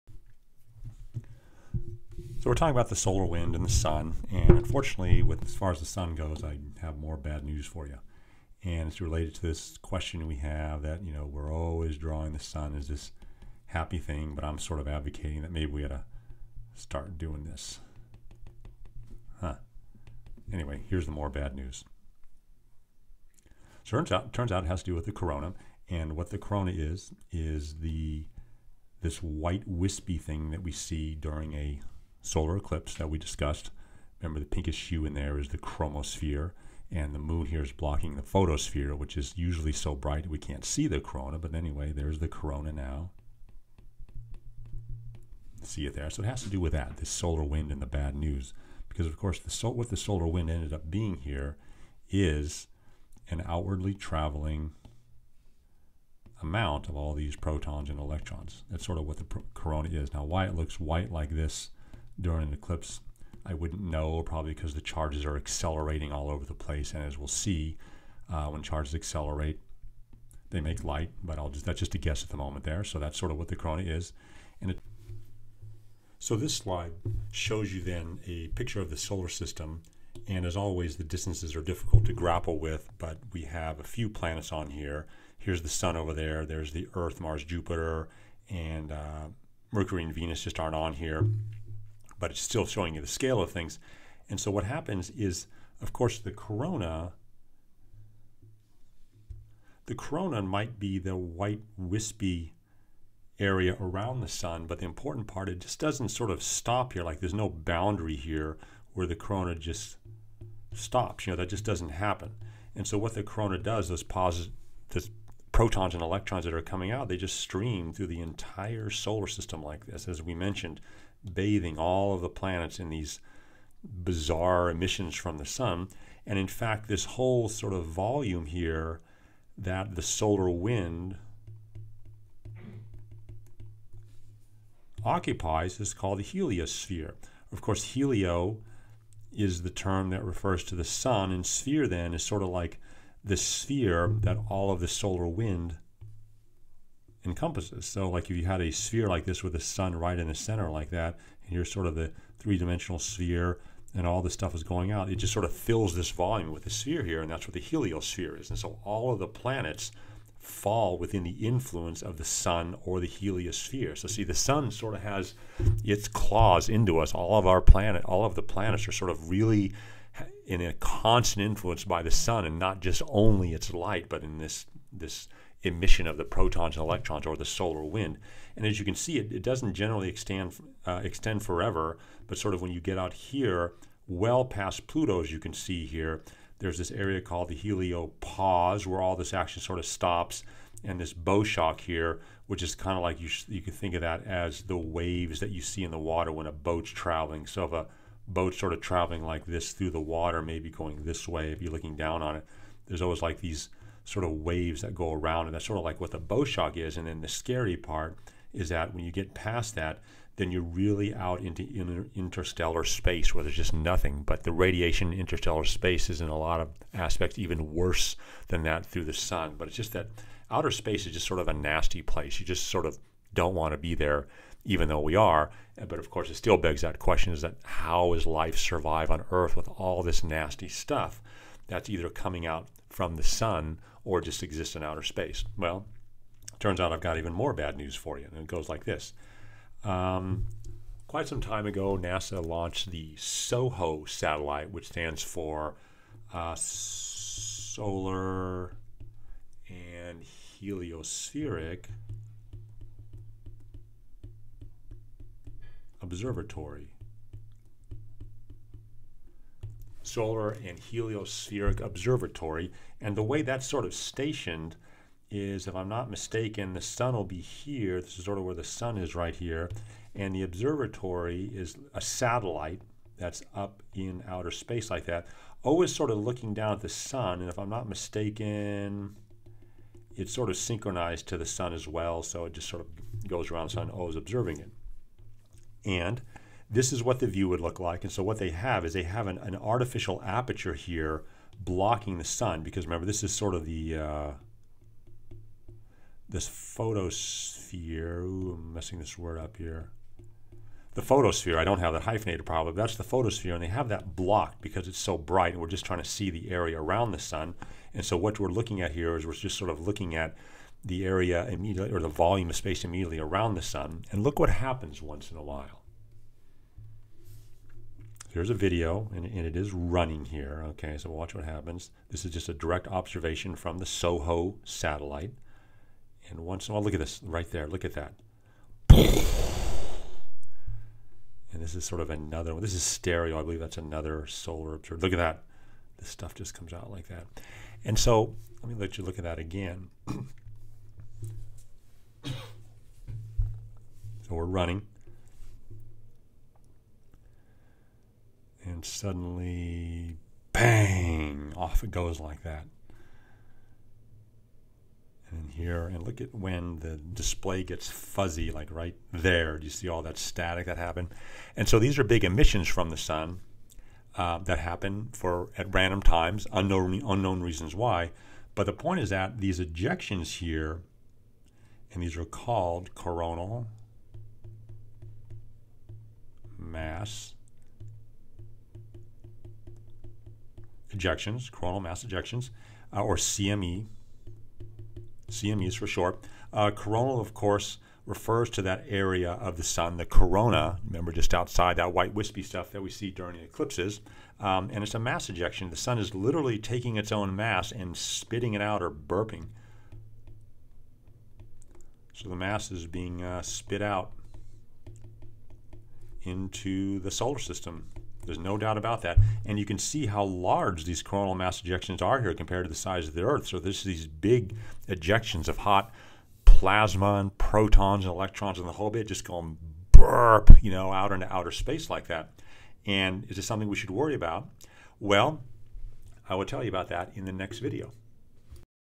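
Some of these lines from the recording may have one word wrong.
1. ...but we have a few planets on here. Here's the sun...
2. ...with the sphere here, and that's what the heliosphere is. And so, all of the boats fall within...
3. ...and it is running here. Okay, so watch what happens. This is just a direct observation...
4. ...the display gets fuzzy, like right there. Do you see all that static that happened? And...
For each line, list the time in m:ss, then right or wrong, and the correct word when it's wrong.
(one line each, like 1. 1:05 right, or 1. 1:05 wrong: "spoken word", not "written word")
1. 1:22 right
2. 2:36 wrong: "planets", not "boats"
3. 5:19 right
4. 5:56 right.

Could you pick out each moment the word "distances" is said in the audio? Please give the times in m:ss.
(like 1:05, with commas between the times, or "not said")
1:21.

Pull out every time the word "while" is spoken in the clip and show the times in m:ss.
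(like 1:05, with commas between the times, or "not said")
5:15, 5:26.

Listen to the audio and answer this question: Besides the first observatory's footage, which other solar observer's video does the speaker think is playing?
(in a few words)
STEREO.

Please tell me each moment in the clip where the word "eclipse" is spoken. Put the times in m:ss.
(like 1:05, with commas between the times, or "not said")
0:32, 1:02, 6:33.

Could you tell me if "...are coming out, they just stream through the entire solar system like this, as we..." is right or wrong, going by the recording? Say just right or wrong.
right.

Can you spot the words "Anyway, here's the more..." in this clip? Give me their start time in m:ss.
0:20.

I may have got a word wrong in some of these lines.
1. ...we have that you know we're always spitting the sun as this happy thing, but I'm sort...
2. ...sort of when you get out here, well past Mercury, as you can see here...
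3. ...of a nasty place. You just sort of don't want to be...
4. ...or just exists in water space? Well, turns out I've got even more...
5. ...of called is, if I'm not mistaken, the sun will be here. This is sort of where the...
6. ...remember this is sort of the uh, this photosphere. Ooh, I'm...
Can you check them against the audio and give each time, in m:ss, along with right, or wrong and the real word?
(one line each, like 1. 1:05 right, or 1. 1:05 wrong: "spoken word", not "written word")
1. 0:10 wrong: "drawing", not "spitting"
2. 3:02 wrong: "Pluto", not "Mercury"
3. 3:41 right
4. 3:54 wrong: "outer", not "water"
5. 4:23 wrong: "stationed", not "called"
6. 4:52 right.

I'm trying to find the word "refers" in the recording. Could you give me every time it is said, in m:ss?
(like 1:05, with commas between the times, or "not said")
2:20, 6:28.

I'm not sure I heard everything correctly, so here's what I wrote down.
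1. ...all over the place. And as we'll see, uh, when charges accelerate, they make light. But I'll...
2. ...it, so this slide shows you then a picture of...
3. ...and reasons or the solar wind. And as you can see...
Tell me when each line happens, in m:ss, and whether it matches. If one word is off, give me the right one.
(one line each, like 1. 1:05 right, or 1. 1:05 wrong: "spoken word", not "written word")
1. 1:06 right
2. 1:14 right
3. 2:56 wrong: "electrons", not "reasons".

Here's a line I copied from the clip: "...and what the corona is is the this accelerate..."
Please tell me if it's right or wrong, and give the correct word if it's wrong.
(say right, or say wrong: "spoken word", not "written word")
wrong: "white", not "accelerate".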